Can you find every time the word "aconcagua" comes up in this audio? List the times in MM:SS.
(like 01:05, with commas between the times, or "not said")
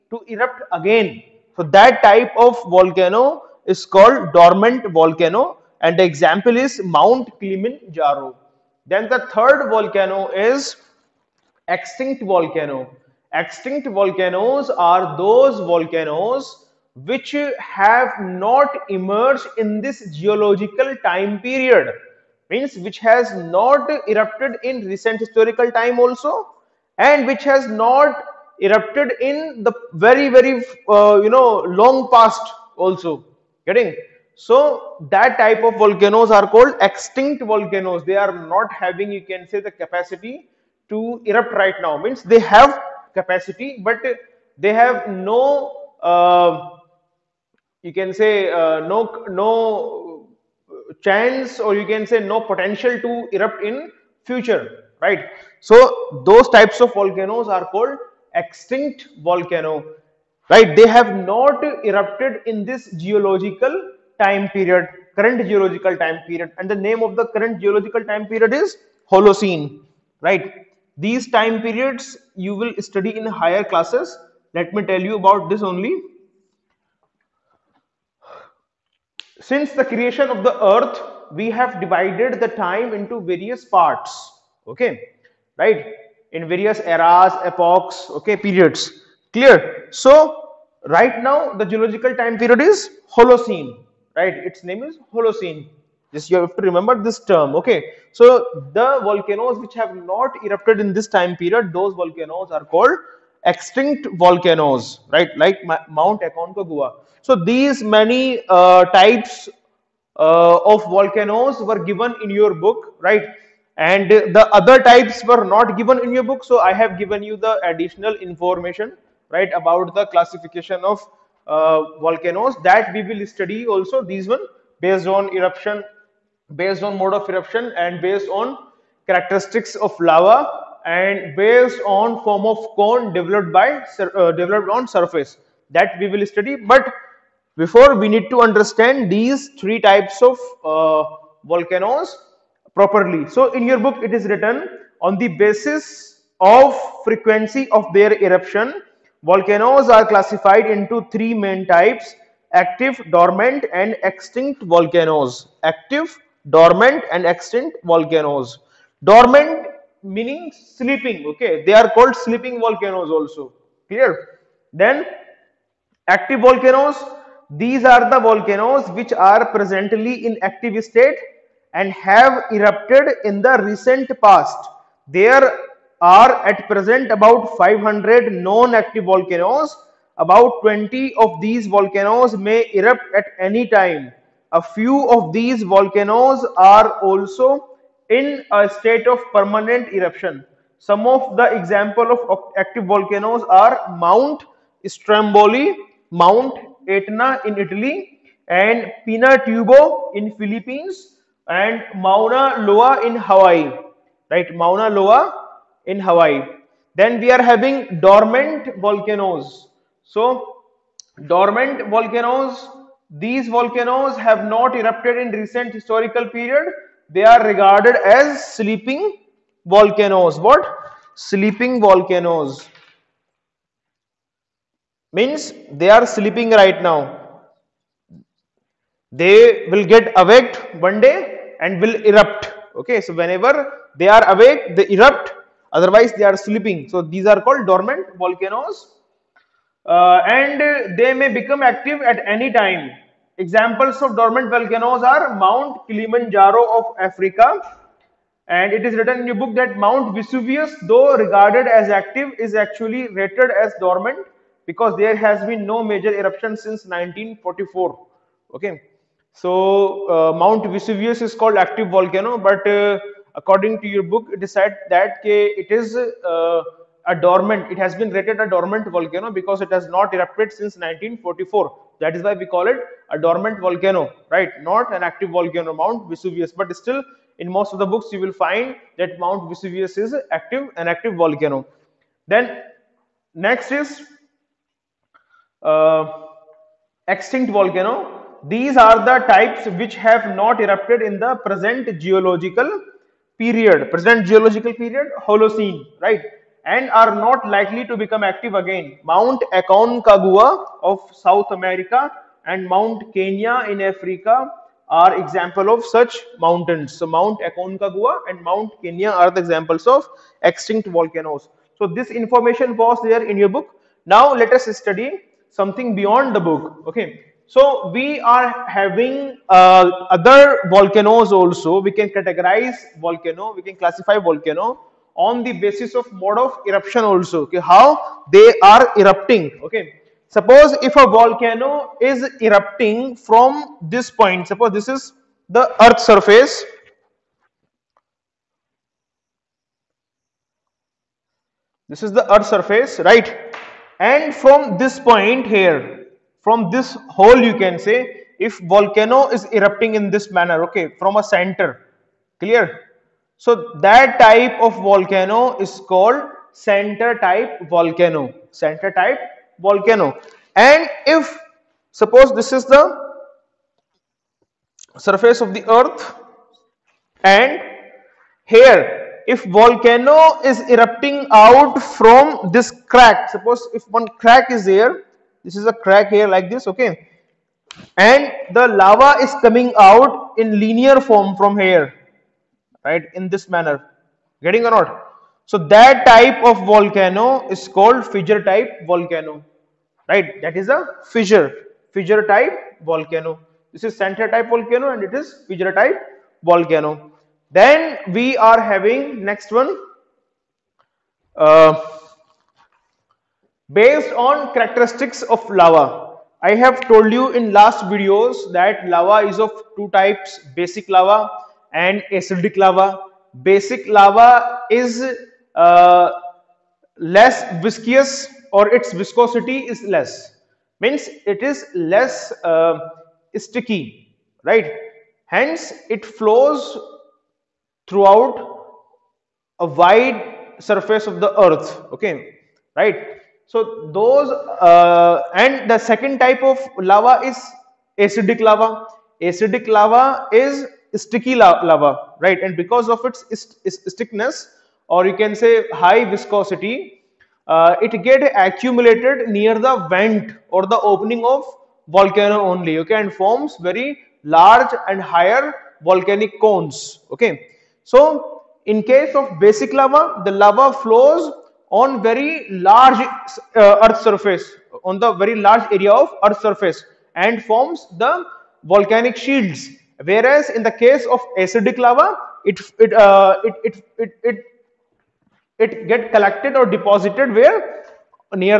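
01:46, 04:59, 05:07.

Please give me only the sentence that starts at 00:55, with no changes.
So those types of volcanoes are called extinct volcano, right?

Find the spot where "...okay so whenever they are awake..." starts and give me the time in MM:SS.
03:52.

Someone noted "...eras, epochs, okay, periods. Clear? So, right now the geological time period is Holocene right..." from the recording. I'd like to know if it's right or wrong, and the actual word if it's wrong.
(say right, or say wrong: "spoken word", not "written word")
right.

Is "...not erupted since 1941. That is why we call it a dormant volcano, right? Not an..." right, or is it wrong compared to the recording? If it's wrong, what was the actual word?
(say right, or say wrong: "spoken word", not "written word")
wrong: "1944", not "1941".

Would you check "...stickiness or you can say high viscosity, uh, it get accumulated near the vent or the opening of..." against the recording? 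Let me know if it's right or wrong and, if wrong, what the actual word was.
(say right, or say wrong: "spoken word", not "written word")
right.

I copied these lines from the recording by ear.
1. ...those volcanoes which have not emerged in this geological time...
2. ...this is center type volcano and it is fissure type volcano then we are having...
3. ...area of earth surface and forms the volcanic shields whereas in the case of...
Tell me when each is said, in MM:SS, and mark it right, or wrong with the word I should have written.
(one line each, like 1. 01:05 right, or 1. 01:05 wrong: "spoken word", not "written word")
1. 00:15 right
2. 06:33 right
3. 07:45 right.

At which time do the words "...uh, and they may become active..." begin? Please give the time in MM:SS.
03:59.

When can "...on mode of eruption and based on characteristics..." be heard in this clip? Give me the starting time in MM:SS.
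02:06.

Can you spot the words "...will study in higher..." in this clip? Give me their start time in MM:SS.
01:12.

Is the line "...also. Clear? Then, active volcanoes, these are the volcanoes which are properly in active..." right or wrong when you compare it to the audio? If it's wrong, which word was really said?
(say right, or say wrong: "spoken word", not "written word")
wrong: "presently", not "properly".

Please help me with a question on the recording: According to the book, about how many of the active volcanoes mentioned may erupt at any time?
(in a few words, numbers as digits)
20.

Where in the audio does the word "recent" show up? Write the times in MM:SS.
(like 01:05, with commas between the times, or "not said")
00:24, 02:53, 03:35.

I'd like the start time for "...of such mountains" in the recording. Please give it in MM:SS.
05:05.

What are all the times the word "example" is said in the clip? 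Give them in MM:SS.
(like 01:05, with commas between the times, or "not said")
00:06, 03:11, 04:03, 05:05, 05:09.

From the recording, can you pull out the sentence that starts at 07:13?
So those uh, and the second type of lava is acidic lava.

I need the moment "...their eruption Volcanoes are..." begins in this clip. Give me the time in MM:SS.
02:27.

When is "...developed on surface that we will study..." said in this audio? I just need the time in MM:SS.
02:14.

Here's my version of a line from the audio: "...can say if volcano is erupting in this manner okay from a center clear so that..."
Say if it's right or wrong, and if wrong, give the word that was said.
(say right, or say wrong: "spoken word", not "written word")
right.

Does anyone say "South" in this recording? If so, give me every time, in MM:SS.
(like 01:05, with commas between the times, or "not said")
05:01.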